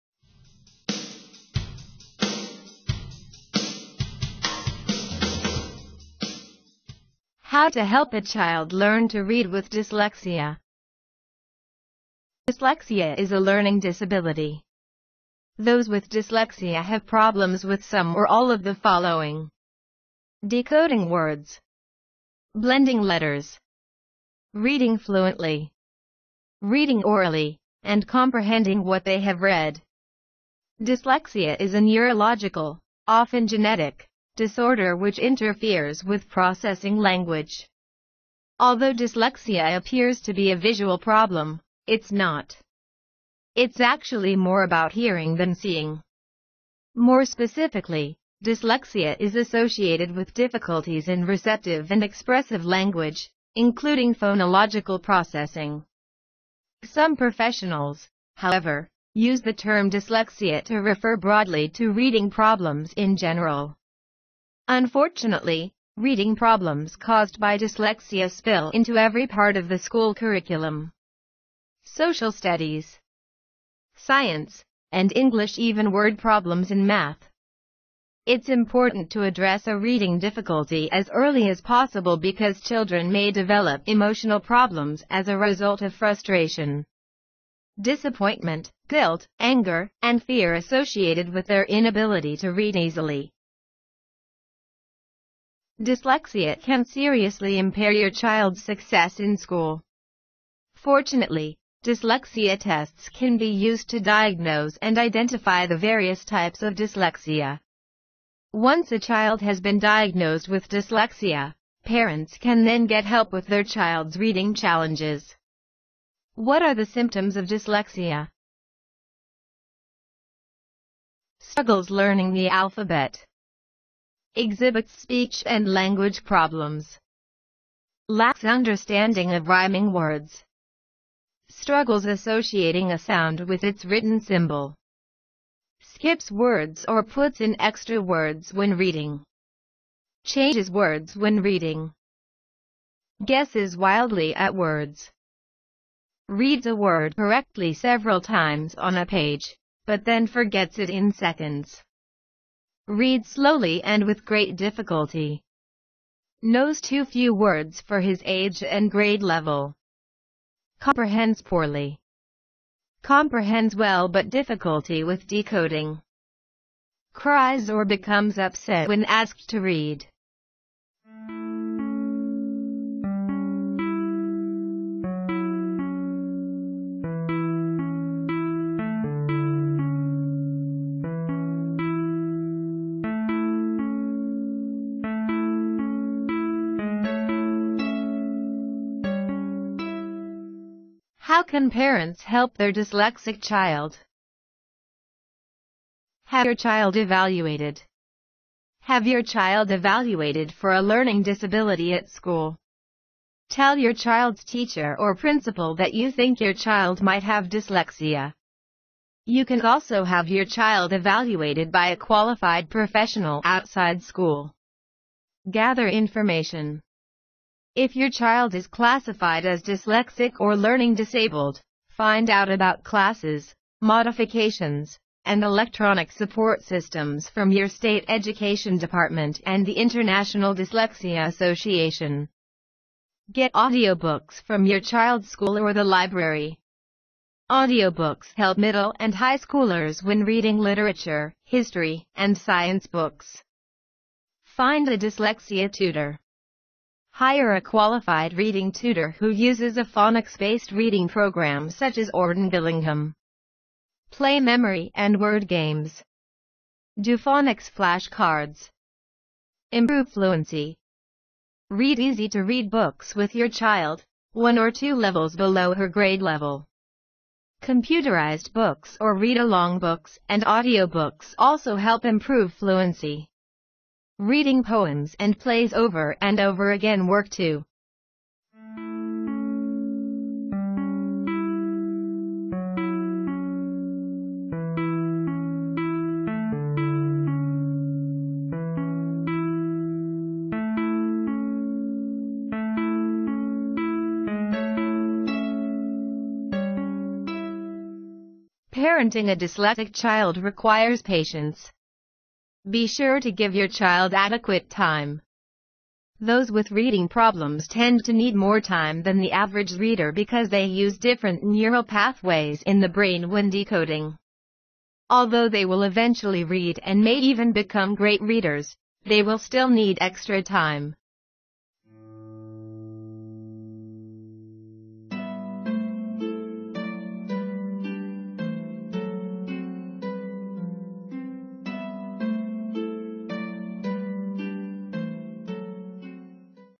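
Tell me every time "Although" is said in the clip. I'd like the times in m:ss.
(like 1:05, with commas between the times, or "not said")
0:38, 5:15.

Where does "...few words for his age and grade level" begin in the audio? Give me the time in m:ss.
2:37.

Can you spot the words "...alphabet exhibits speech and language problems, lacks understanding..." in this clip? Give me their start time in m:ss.
2:02.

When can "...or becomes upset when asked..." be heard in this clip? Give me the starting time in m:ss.
2:47.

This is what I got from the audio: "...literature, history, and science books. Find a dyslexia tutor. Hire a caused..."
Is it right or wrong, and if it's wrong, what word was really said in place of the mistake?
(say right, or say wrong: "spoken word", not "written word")
wrong: "qualified", not "caused".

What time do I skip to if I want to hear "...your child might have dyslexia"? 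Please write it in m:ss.
3:26.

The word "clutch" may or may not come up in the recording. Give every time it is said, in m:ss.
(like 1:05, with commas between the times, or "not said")
not said.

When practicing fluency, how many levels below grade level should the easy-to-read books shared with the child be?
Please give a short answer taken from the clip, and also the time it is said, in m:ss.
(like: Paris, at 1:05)
1 or 2, at 4:24.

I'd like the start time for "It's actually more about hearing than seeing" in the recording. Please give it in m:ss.
0:43.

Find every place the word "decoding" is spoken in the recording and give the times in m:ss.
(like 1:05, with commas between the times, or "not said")
0:20, 2:45, 5:13.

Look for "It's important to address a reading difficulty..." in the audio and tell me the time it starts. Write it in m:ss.
1:18.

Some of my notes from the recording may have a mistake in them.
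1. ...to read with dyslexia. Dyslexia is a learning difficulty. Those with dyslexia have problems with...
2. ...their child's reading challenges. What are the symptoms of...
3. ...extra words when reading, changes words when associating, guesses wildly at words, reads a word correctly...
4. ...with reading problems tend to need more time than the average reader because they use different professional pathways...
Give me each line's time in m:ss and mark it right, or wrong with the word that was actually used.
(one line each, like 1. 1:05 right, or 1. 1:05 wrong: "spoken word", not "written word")
1. 0:09 wrong: "disability", not "difficulty"
2. 1:53 right
3. 2:17 wrong: "reading", not "associating"
4. 5:06 wrong: "neural", not "professional".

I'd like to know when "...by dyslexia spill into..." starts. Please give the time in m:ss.
1:07.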